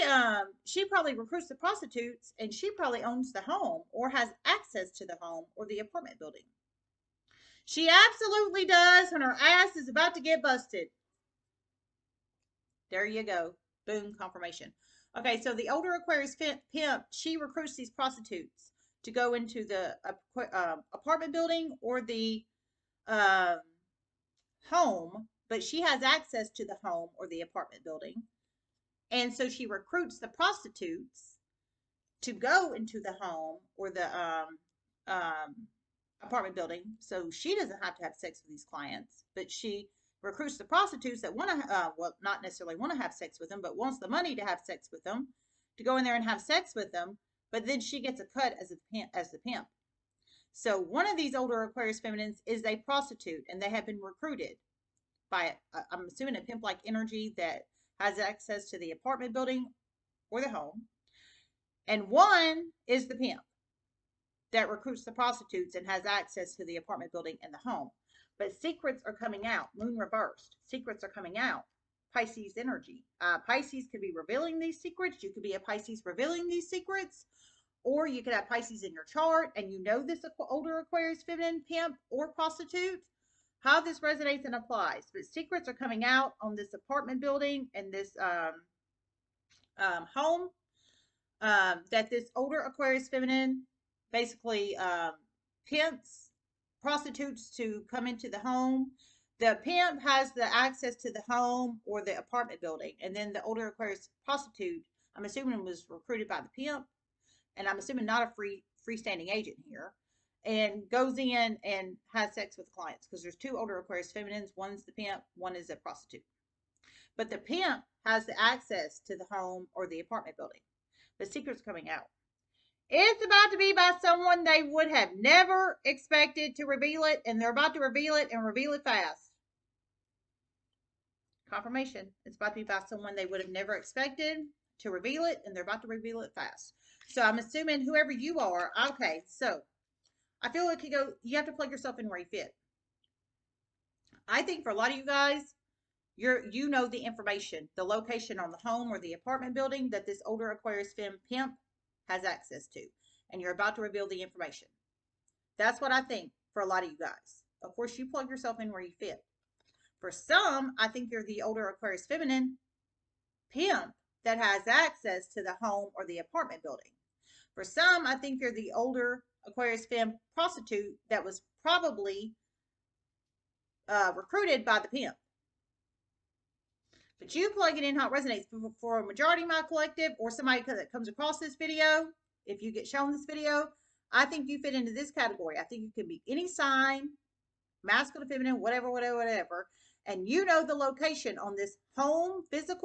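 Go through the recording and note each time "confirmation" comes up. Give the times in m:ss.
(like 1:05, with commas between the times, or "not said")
0:14, 2:11.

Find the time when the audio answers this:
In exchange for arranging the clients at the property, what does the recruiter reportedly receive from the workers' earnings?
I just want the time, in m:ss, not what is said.
0:48.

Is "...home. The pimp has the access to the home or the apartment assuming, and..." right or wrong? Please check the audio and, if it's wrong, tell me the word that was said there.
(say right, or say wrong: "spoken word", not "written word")
wrong: "building", not "assuming".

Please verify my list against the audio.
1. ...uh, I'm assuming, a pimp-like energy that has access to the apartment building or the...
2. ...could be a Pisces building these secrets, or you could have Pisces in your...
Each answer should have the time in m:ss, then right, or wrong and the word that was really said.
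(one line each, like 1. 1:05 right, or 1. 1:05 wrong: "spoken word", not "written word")
1. 0:55 right
2. 1:15 wrong: "revealing", not "building".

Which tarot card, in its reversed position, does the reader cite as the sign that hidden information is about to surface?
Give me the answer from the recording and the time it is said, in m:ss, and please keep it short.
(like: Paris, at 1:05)
Moon reversed, at 1:09.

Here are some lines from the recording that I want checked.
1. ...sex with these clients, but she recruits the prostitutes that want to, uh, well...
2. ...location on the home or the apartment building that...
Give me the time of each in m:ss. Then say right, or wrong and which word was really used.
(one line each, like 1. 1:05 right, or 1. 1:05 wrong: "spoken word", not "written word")
1. 0:38 right
2. 2:27 right.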